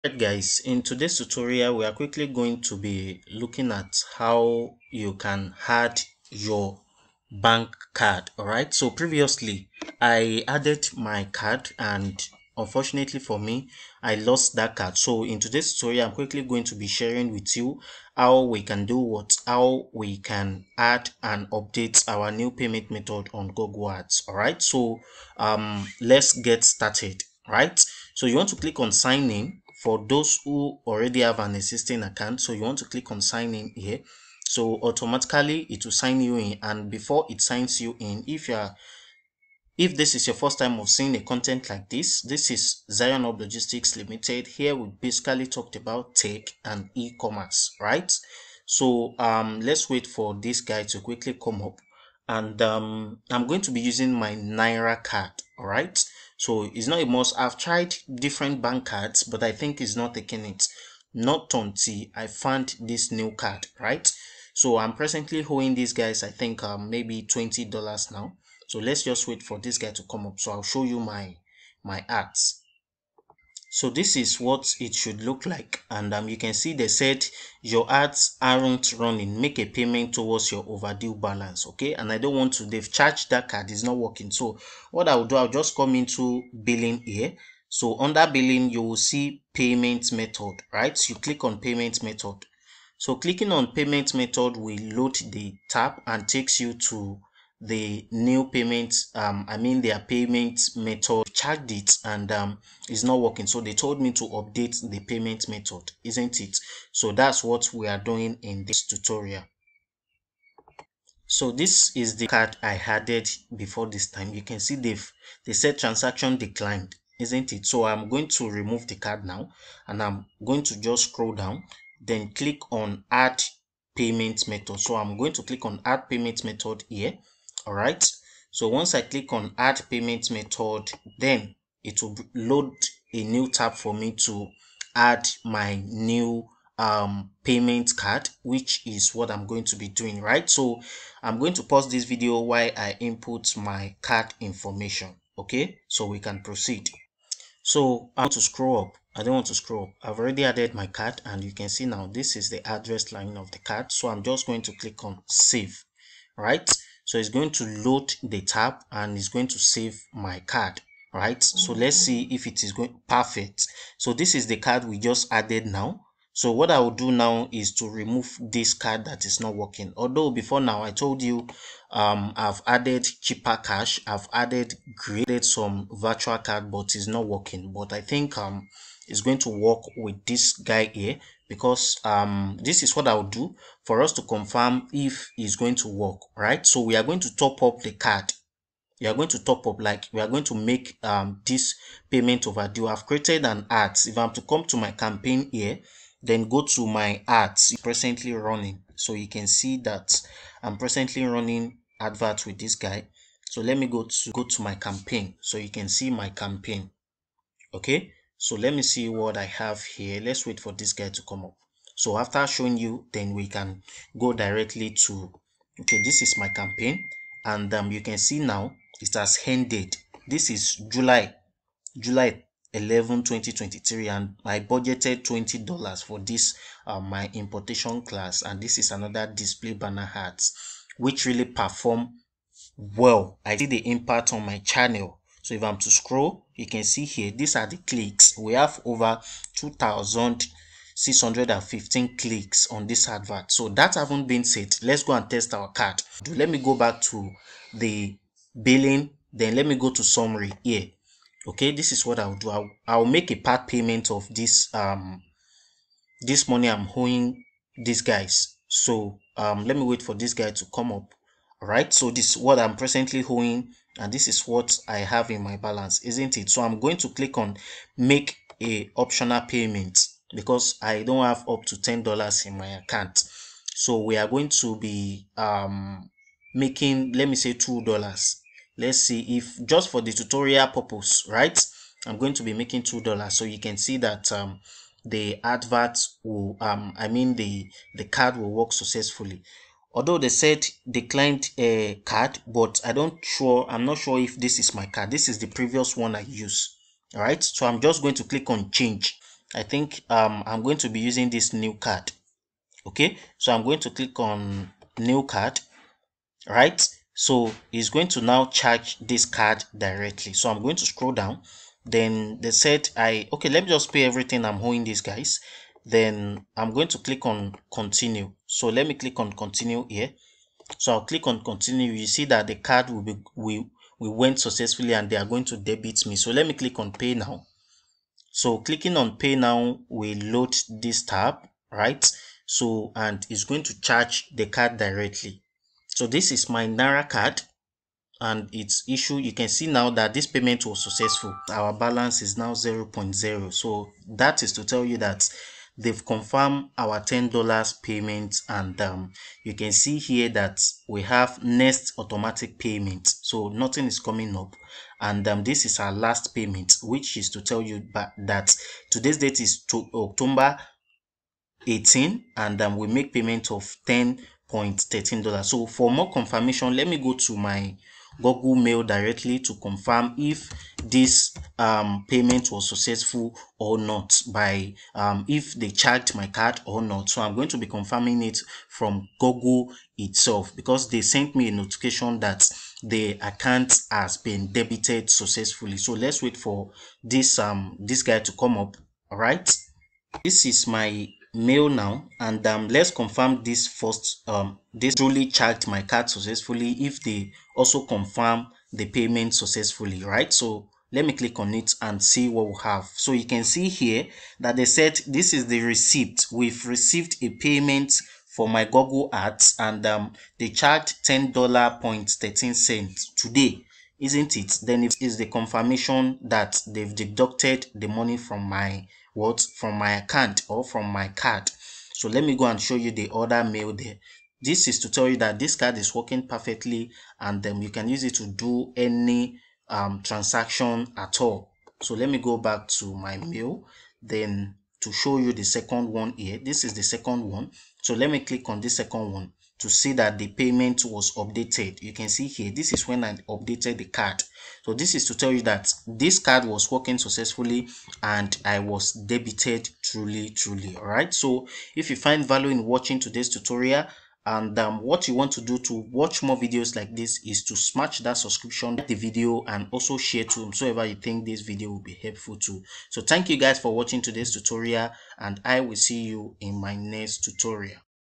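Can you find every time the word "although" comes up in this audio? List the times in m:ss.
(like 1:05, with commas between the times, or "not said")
2:49, 4:49.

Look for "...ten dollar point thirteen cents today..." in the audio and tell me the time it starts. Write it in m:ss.
6:51.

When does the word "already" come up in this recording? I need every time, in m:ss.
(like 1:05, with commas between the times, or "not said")
0:30, 2:30.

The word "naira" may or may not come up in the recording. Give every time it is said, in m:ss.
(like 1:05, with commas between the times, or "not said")
0:54, 5:36.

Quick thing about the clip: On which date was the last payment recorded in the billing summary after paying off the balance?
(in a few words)
October 18.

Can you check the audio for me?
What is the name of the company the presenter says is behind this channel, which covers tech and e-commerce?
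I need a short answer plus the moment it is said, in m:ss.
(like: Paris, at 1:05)
Zion Hub Logistics Limited, at 0:42.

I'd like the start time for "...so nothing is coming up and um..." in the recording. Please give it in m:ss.
5:53.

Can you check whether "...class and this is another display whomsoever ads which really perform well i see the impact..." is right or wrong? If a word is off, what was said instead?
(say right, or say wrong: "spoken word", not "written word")
wrong: "banner", not "whomsoever".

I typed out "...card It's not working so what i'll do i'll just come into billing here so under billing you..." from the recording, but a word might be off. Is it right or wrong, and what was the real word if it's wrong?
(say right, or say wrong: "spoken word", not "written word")
right.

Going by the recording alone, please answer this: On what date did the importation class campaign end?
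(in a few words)
July 11, 2023.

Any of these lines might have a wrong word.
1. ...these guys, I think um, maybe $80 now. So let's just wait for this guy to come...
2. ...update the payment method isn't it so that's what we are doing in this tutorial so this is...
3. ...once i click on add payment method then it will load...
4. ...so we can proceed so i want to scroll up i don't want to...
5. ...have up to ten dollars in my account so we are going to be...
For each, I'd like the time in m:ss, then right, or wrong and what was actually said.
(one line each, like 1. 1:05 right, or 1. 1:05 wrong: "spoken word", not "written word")
1. 1:05 wrong: "20", not "80"
2. 1:44 right
3. 2:08 right
4. 2:25 right
5. 4:31 right.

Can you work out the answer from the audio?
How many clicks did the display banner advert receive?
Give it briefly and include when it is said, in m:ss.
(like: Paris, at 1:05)
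2615, at 3:59.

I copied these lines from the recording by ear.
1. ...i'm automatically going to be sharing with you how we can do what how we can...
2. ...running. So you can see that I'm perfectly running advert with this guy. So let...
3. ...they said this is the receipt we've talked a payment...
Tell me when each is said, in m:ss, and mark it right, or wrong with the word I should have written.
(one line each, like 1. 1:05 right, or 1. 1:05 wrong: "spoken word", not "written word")
1. 0:16 wrong: "quickly", not "automatically"
2. 3:18 wrong: "presently", not "perfectly"
3. 6:44 wrong: "received", not "talked".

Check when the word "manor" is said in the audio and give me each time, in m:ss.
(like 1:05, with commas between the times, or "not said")
not said.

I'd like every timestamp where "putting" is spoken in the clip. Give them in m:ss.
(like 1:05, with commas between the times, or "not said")
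not said.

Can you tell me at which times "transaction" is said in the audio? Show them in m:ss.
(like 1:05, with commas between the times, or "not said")
1:55, 7:10.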